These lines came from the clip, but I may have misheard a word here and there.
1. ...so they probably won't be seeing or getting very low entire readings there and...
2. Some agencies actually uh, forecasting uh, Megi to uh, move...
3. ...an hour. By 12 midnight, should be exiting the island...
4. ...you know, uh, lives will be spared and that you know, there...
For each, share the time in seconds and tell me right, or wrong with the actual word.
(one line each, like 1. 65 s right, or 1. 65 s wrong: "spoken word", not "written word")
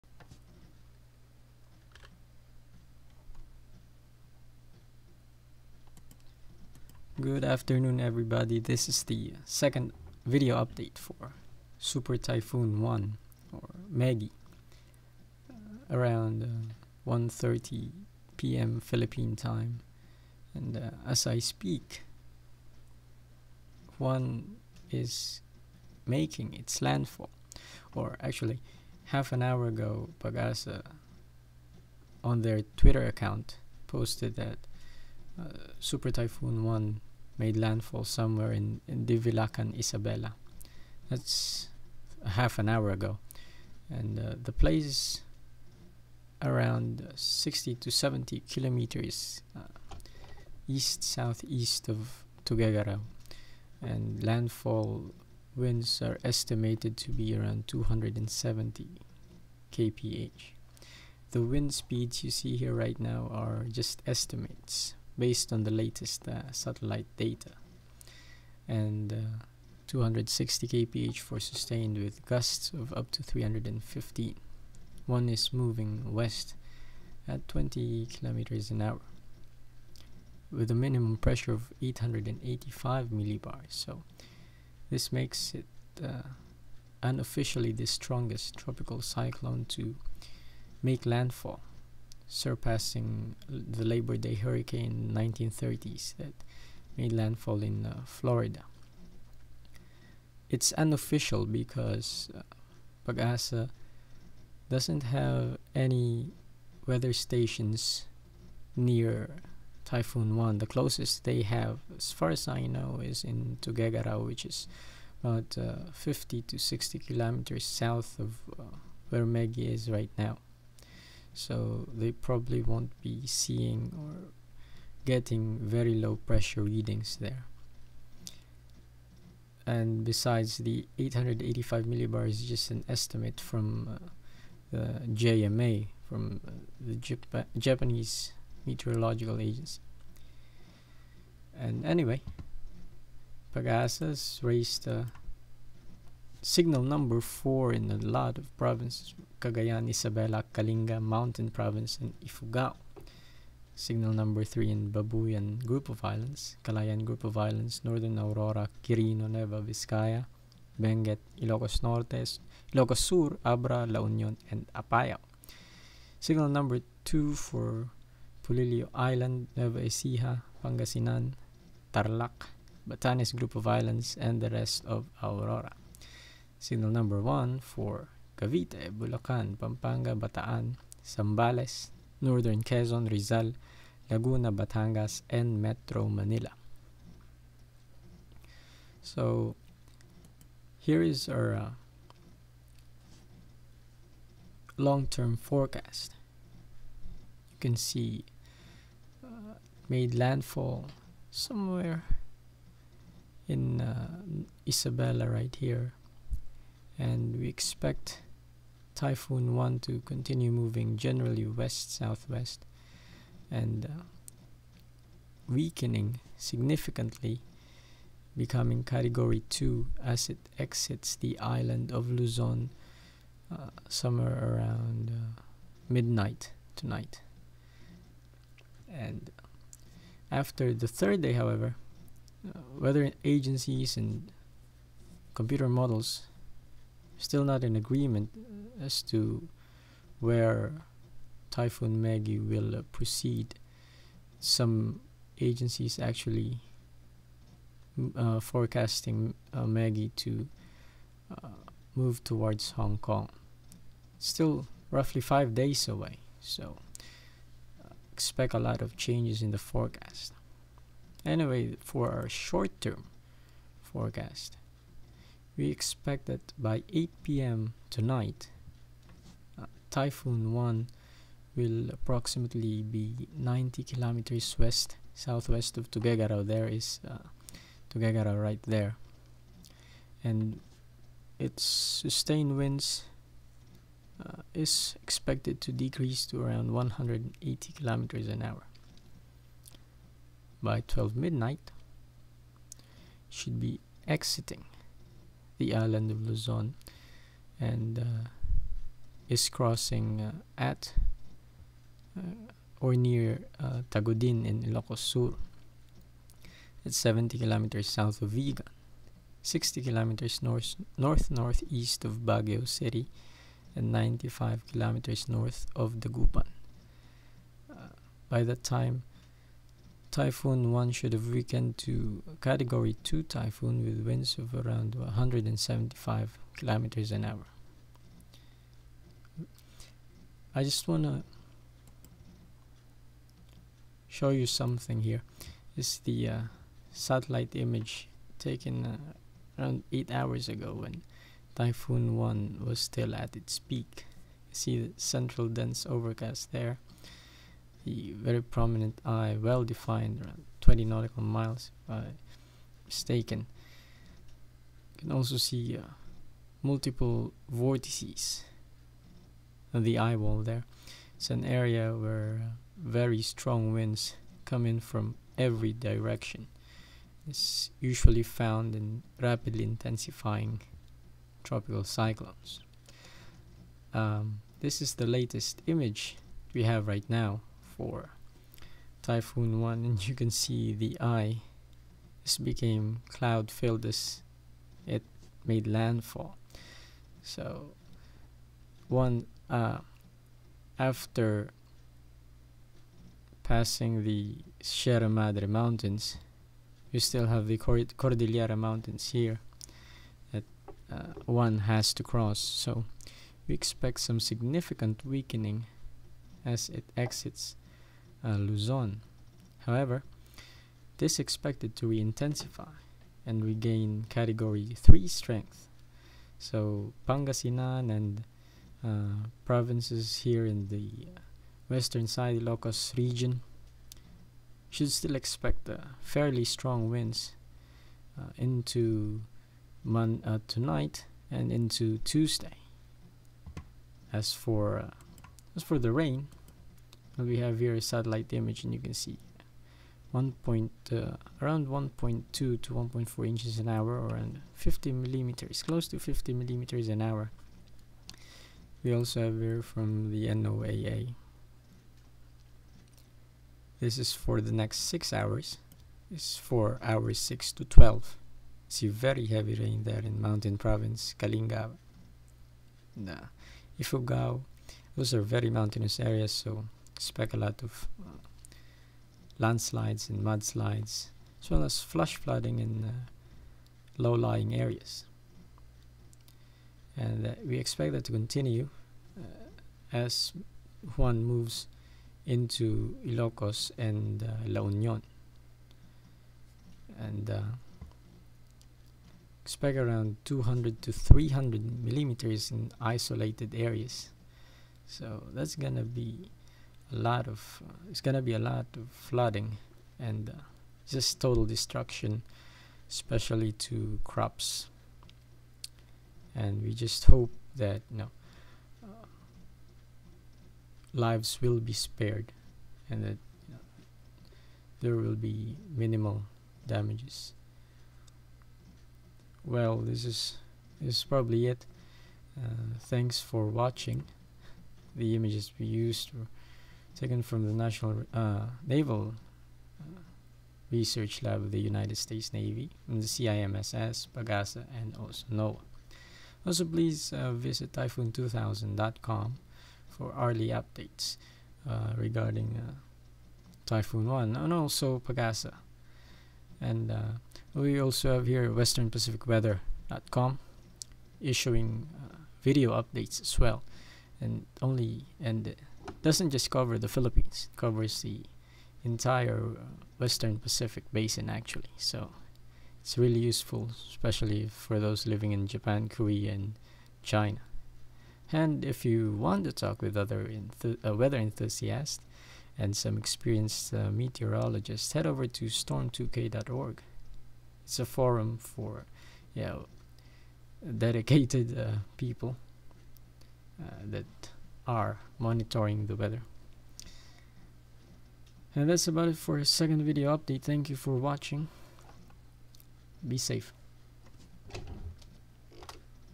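1. 121 s wrong: "pressure", not "entire"
2. 244 s right
3. 288 s right
4. 507 s right.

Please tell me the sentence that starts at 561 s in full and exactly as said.
So it's really useful, especially for those living in Japan, Korea, and China.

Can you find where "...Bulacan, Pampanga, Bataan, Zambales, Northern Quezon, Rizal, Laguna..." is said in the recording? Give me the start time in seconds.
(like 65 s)
178 s.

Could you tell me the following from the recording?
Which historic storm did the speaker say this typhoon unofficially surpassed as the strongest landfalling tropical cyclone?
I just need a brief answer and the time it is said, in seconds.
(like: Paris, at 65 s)
Labor Day hurricane, at 93 s.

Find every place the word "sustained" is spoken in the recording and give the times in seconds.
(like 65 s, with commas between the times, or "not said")
71 s, 281 s.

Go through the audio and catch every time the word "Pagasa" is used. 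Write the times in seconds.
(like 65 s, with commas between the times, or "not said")
30 s, 103 s, 143 s, 534 s, 545 s.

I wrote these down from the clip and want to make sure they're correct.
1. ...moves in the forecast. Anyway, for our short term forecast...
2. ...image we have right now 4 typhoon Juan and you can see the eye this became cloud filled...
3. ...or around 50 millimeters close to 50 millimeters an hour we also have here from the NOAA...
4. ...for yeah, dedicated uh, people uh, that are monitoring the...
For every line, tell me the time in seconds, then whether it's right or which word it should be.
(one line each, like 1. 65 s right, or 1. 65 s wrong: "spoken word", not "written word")
1. 258 s wrong: "changes", not "moves"
2. 375 s right
3. 443 s right
4. 578 s right.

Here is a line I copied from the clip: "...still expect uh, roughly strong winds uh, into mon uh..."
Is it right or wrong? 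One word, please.
wrong.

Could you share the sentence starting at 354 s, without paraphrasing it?
You can also see uh, multiple vortices on the eye wall there.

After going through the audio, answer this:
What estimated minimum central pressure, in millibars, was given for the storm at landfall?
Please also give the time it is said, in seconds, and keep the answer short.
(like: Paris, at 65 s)
885, at 81 s.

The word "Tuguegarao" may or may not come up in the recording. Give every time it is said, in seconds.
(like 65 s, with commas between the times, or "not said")
52 s, 113 s, 275 s.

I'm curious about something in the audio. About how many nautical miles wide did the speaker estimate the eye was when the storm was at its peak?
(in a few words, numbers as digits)
20.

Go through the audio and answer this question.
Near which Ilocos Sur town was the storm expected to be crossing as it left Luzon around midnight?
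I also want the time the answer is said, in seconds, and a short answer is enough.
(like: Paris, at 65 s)
Tagudin, at 303 s.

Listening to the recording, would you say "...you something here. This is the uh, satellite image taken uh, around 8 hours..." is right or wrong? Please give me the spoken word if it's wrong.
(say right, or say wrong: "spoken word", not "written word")
right.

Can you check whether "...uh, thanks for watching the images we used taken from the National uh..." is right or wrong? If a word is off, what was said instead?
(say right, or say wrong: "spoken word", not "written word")
right.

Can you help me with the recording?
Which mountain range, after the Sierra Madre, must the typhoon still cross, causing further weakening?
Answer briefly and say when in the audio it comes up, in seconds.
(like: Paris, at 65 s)
Cordillera mountains, at 398 s.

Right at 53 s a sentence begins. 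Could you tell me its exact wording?
And landfall winds are estimated to be around 270 kph.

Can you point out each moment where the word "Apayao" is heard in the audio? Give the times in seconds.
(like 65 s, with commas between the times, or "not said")
164 s.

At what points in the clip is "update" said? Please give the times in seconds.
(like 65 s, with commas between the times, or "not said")
10 s, 540 s, 552 s, 590 s.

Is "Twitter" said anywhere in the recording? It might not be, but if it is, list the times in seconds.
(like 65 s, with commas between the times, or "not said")
32 s.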